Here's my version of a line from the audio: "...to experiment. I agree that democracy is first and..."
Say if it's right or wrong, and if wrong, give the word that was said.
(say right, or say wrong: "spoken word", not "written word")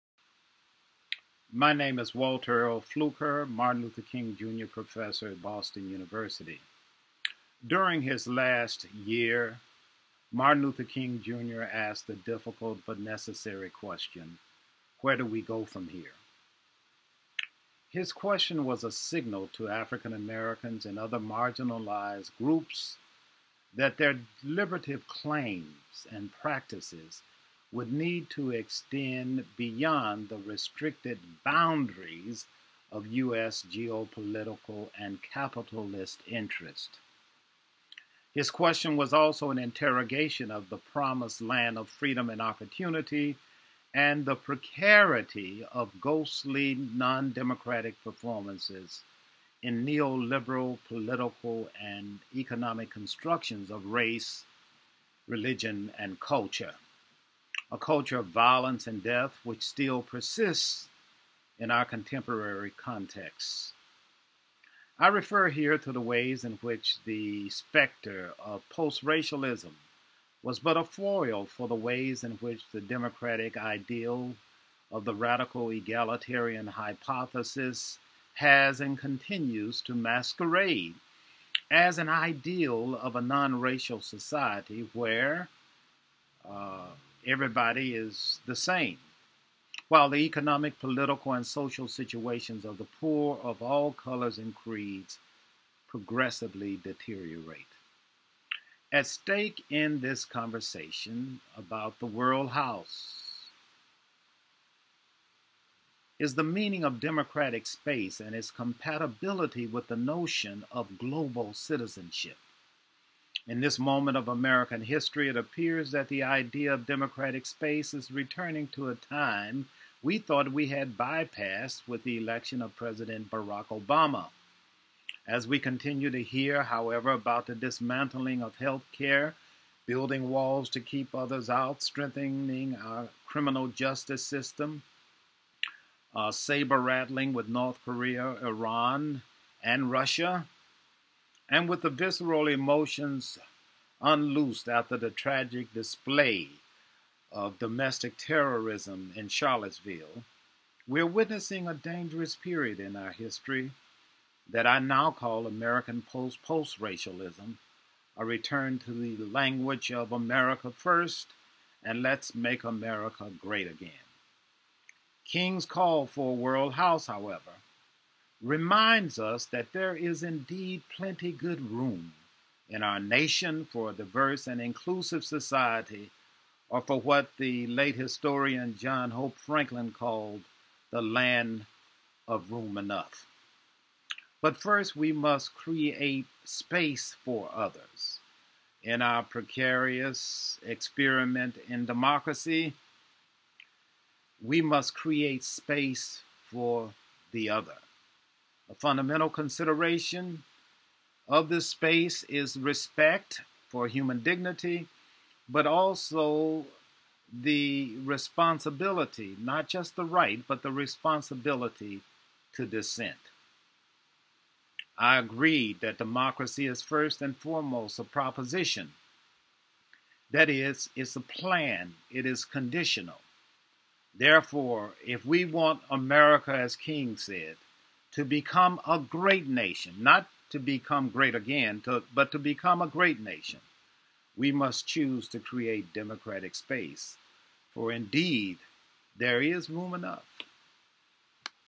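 wrong: "dissent", not "experiment".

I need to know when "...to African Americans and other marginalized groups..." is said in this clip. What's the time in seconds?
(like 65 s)
19 s.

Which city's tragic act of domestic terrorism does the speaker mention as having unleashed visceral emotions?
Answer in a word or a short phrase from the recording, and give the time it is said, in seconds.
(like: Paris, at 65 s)
Charlottesville, at 149 s.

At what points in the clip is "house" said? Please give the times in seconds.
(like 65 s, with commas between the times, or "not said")
102 s, 166 s.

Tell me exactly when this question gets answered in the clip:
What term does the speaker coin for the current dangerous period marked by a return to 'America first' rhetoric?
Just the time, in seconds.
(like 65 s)
155 s.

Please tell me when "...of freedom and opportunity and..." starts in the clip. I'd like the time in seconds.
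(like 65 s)
41 s.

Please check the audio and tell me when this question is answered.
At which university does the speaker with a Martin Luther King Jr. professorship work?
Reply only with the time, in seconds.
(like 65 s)
5 s.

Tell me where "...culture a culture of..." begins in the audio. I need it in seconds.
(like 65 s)
56 s.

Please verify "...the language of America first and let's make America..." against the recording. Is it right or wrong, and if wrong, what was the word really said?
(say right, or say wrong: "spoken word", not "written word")
right.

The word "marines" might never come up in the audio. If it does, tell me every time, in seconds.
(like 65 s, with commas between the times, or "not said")
not said.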